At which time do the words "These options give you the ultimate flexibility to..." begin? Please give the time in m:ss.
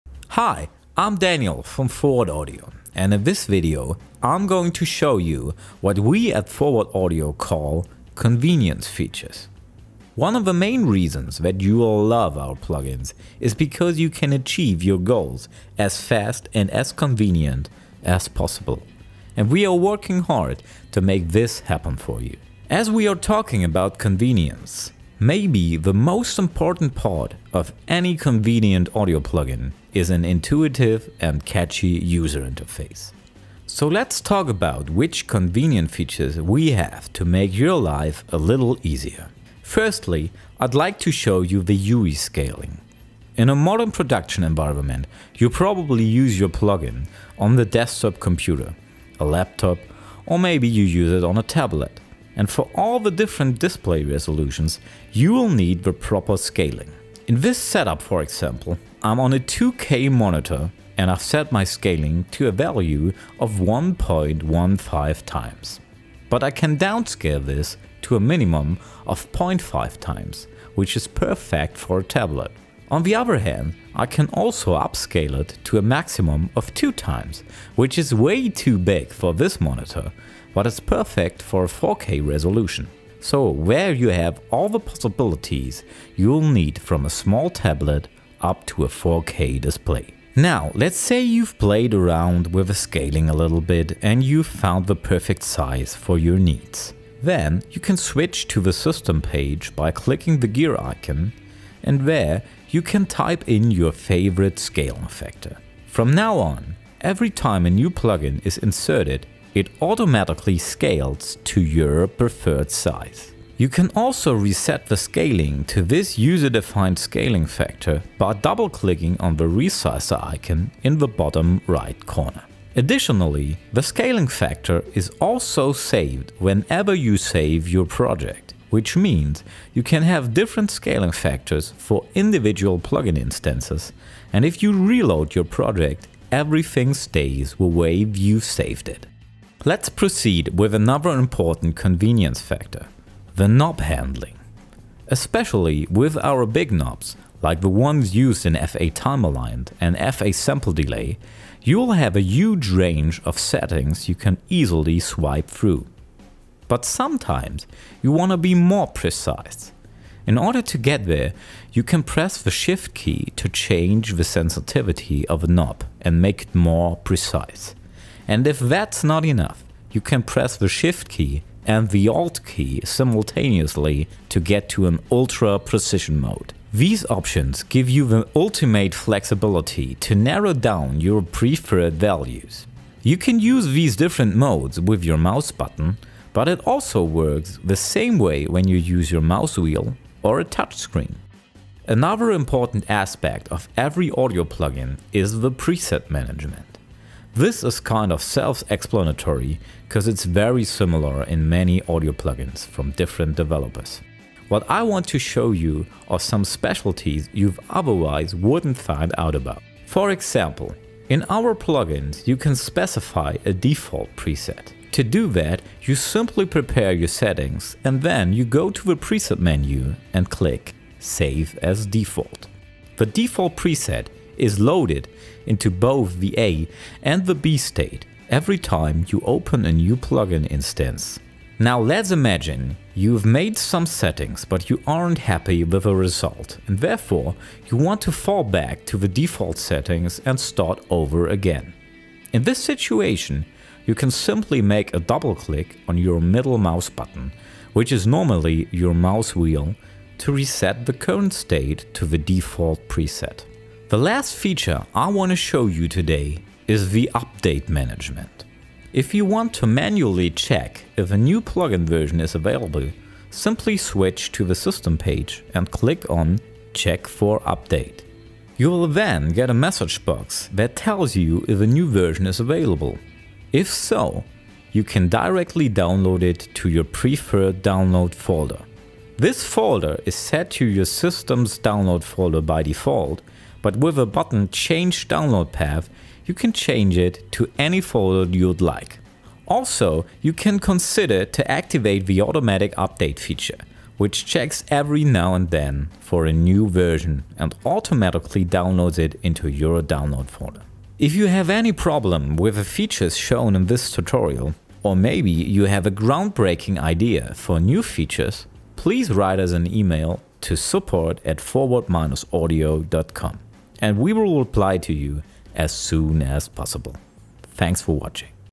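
2:56.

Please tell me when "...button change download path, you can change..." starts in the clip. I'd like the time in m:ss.
4:44.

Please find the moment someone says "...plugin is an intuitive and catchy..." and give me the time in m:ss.
0:29.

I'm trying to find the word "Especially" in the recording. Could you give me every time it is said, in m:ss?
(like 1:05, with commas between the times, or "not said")
2:25.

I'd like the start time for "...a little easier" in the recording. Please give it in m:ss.
0:38.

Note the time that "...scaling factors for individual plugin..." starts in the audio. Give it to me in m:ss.
2:10.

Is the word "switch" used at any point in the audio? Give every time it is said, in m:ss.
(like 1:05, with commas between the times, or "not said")
1:37, 4:23.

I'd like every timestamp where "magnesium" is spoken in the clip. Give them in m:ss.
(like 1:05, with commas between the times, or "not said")
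not said.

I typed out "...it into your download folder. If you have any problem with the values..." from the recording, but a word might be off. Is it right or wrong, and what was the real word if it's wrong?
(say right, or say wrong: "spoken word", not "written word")
wrong: "features", not "values".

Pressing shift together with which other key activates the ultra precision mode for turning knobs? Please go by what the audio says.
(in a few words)
Alt.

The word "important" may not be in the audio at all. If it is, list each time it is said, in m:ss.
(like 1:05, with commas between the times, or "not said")
0:26, 2:21, 3:12.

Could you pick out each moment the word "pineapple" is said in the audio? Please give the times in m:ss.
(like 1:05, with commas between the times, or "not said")
not said.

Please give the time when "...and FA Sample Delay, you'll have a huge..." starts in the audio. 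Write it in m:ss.
2:29.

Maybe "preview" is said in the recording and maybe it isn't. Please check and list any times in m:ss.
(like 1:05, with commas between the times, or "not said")
not said.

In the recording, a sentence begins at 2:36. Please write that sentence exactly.
But sometimes you want to be more precise.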